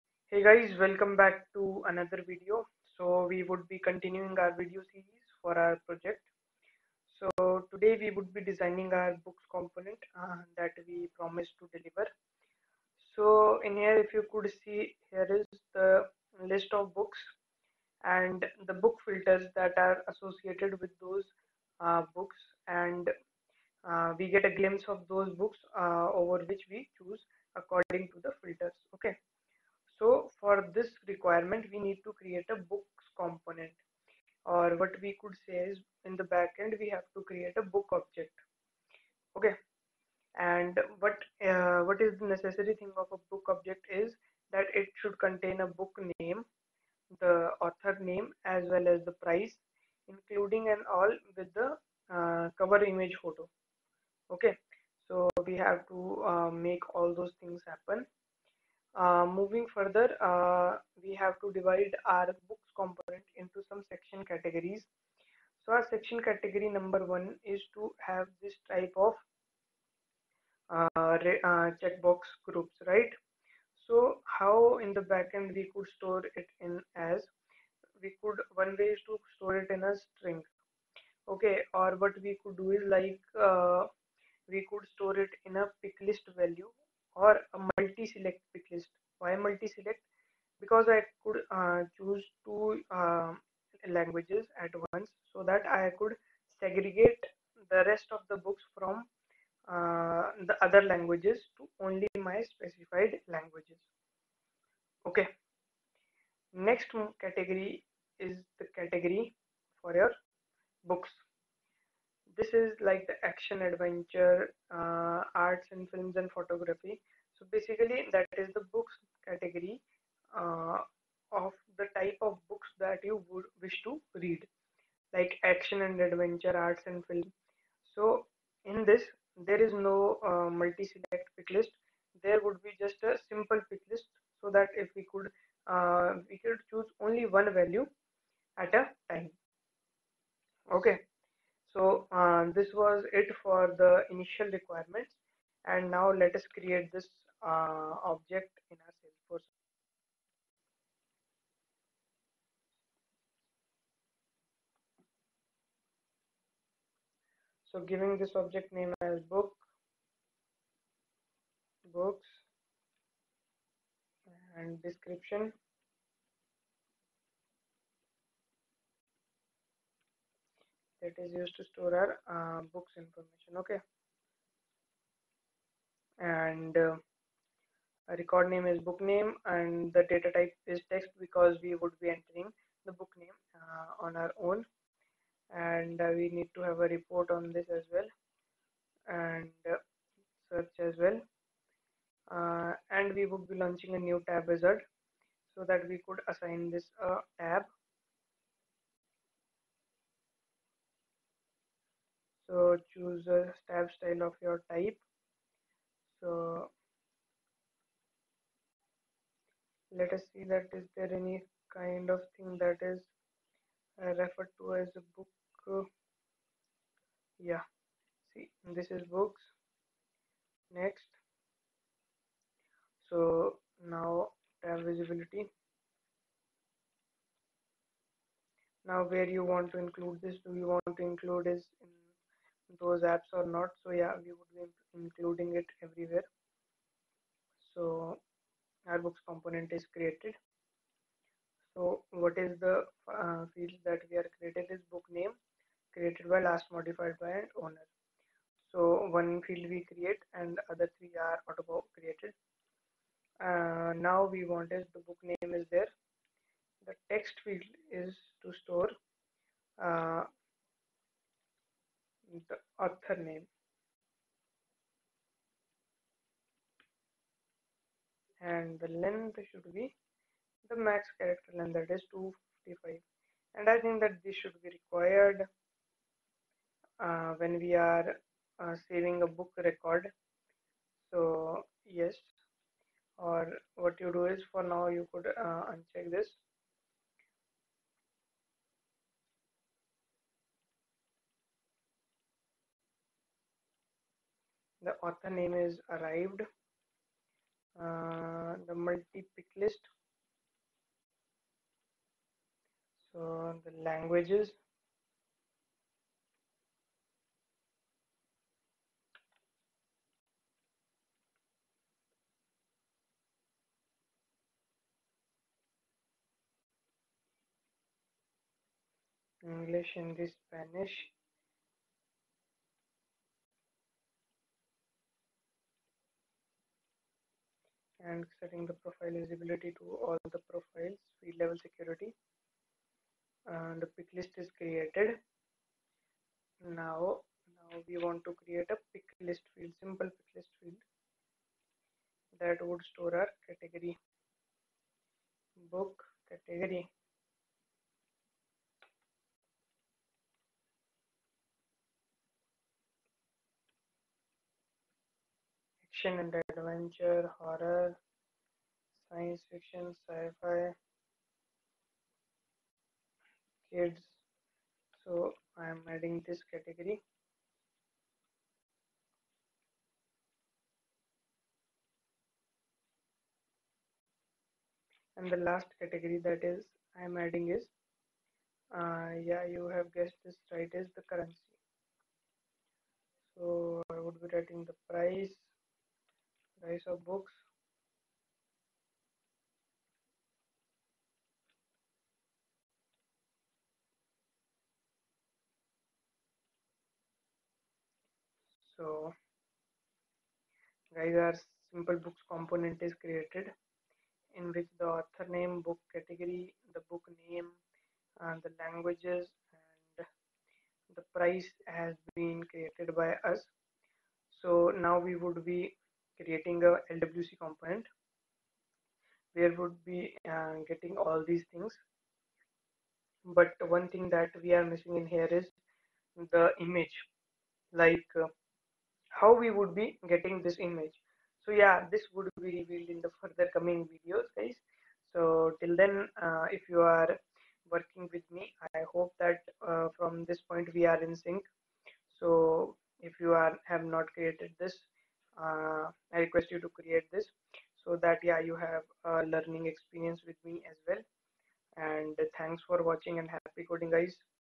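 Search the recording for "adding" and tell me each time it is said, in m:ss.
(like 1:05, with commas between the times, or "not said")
6:05, 6:17.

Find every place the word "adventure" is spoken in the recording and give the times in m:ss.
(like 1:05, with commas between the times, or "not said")
1:53, 2:06, 5:56.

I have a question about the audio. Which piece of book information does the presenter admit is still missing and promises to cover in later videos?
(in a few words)
the image.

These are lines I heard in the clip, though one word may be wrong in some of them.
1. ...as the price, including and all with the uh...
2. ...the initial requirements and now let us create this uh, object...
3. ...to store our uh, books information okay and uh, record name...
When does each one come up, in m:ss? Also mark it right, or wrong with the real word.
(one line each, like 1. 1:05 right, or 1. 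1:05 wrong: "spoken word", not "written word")
1. 0:48 right
2. 2:23 right
3. 2:51 right.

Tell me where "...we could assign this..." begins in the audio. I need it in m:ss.
3:15.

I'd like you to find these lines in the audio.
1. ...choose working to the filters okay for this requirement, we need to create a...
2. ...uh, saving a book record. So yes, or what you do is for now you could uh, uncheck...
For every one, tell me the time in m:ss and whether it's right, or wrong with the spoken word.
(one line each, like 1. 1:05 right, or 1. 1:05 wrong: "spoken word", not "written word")
1. 0:26 wrong: "according", not "working"
2. 4:38 right.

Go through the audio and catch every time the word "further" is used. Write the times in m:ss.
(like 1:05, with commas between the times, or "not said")
0:59, 7:13.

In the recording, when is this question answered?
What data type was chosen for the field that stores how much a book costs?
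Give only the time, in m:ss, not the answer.
6:21.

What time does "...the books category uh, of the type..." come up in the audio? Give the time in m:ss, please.
1:58.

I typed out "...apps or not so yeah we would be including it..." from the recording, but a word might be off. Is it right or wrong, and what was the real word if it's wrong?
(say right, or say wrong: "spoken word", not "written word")
right.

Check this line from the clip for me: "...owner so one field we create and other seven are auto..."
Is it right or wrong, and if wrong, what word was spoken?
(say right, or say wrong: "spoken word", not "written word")
wrong: "three", not "seven".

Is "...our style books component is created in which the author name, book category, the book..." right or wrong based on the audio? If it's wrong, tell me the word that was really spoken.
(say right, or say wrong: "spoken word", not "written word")
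wrong: "simple", not "style".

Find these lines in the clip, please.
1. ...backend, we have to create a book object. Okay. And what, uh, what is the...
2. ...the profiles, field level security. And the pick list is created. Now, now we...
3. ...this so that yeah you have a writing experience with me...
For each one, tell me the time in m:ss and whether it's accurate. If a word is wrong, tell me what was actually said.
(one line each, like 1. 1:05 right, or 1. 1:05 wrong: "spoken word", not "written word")
1. 0:36 right
2. 5:30 right
3. 7:27 wrong: "learning", not "writing".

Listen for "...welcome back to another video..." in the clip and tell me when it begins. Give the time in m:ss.
0:00.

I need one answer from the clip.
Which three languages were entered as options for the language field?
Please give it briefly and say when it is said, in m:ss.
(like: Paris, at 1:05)
English, Hindi, Spanish, at 5:19.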